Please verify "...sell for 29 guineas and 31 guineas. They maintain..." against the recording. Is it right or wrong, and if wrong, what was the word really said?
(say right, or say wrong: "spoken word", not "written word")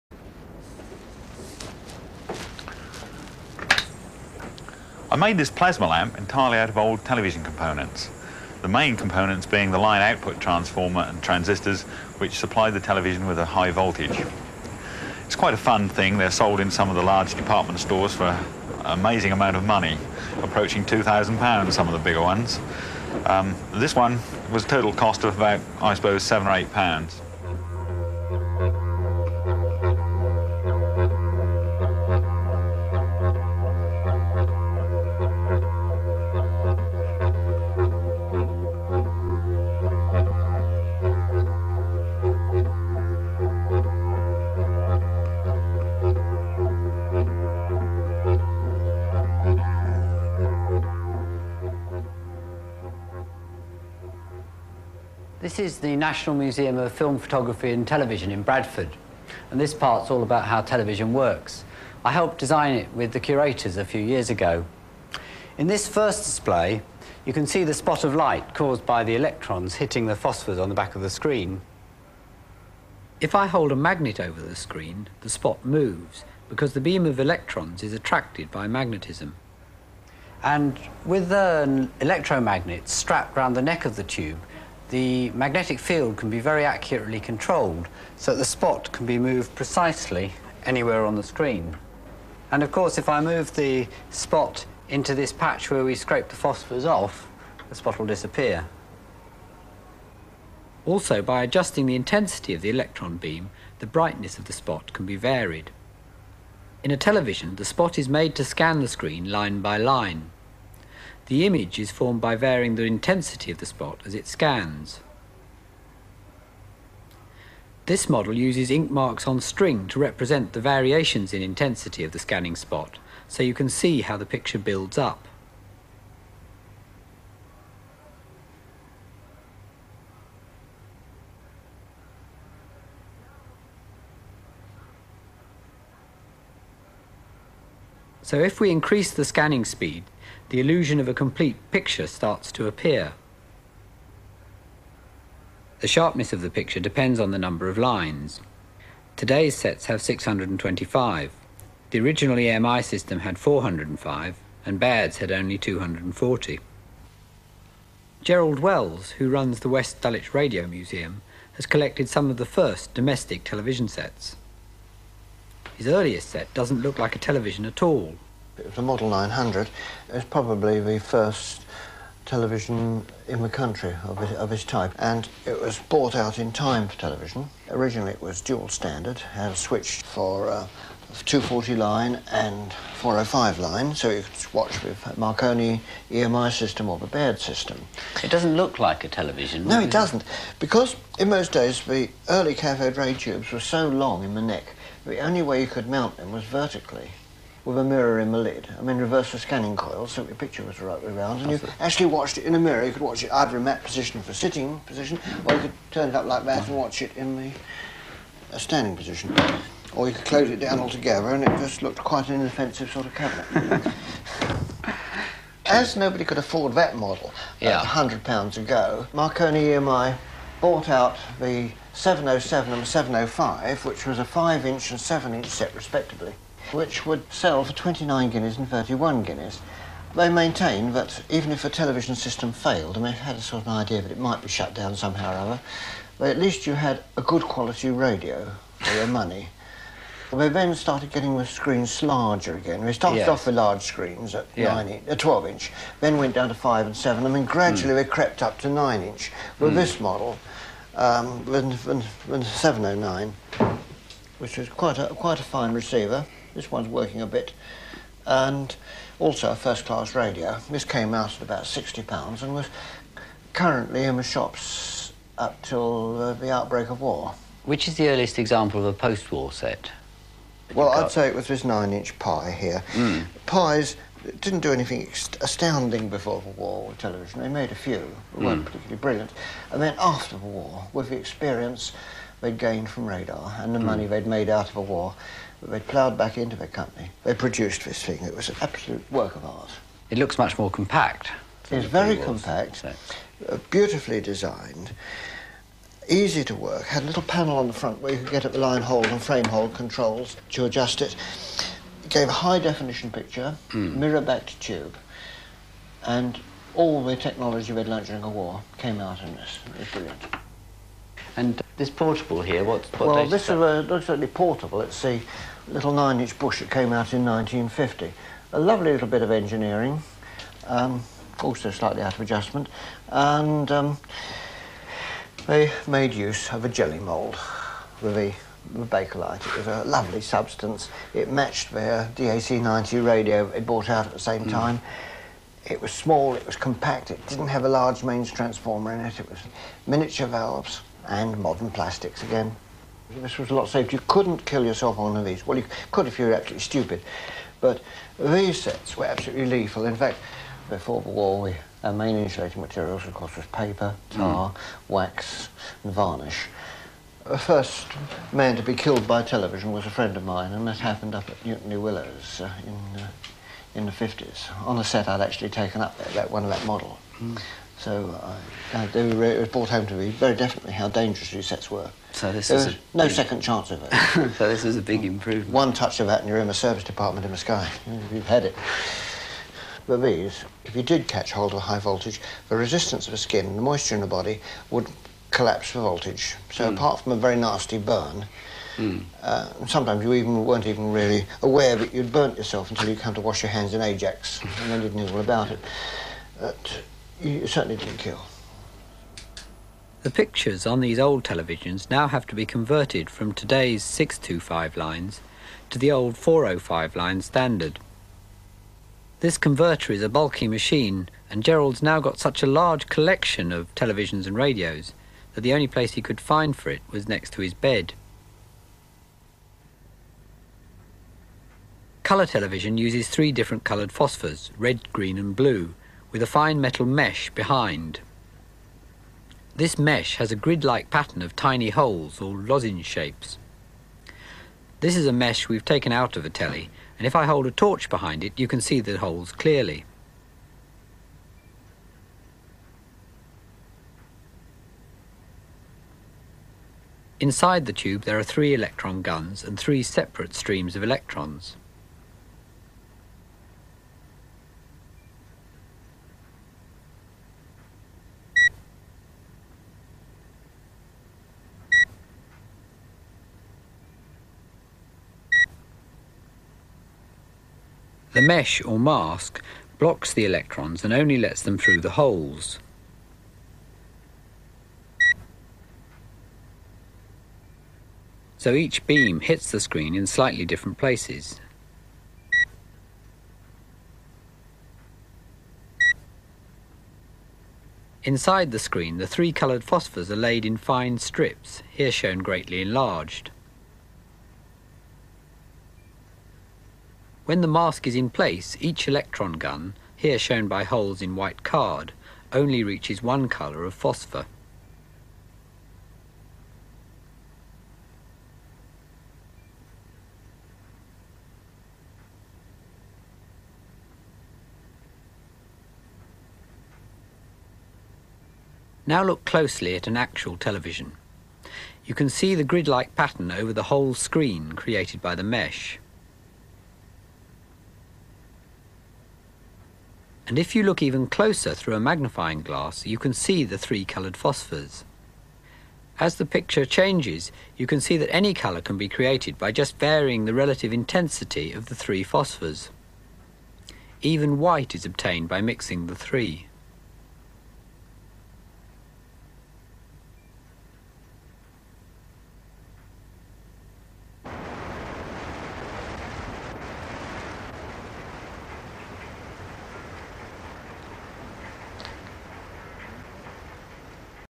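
right.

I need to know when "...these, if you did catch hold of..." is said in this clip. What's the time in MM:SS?
06:20.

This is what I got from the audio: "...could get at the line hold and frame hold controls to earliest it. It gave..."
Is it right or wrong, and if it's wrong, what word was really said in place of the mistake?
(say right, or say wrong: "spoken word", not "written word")
wrong: "adjust", not "earliest".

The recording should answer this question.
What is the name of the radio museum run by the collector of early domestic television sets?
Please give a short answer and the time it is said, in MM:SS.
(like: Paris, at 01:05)
West Dulwich Radio Museum, at 02:39.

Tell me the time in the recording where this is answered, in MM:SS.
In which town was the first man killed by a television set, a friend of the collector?
06:01.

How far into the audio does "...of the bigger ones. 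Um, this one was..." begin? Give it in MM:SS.
00:21.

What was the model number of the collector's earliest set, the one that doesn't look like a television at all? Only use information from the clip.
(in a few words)
900.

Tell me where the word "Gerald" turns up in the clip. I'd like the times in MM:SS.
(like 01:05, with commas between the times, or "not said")
02:38, 06:51.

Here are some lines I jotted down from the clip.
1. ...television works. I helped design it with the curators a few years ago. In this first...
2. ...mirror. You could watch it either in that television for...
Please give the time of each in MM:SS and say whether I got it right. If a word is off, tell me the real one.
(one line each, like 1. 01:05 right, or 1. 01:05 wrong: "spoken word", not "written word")
1. 01:00 right
2. 03:22 wrong: "position", not "television".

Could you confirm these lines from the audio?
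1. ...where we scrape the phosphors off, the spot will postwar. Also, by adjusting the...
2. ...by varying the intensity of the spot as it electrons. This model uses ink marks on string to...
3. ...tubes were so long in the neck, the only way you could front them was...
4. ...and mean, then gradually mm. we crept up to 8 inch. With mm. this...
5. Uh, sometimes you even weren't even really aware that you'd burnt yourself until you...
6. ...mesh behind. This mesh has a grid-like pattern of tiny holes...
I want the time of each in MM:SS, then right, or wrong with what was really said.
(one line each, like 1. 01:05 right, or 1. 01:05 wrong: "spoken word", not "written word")
1. 01:35 wrong: "disappear", not "postwar"
2. 01:52 wrong: "scans", not "electrons"
3. 03:13 wrong: "mount", not "front"
4. 04:07 wrong: "9", not "8"
5. 06:29 right
6. 07:06 right.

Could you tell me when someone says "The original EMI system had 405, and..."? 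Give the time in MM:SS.
02:31.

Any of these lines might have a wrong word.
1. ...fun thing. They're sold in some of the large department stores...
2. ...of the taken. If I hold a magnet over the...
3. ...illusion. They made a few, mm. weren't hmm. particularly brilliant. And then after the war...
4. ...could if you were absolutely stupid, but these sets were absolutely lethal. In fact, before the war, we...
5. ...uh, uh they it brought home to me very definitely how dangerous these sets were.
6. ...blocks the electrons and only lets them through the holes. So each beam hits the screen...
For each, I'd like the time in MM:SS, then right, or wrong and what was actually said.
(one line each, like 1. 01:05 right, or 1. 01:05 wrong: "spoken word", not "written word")
1. 00:15 right
2. 01:10 wrong: "screen", not "taken"
3. 04:36 wrong: "television", not "illusion"
4. 05:45 right
5. 06:08 right
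6. 07:49 right.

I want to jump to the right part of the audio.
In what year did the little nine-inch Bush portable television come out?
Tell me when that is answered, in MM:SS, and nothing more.
05:17.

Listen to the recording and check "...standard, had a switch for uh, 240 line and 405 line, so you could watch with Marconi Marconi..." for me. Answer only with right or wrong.
wrong.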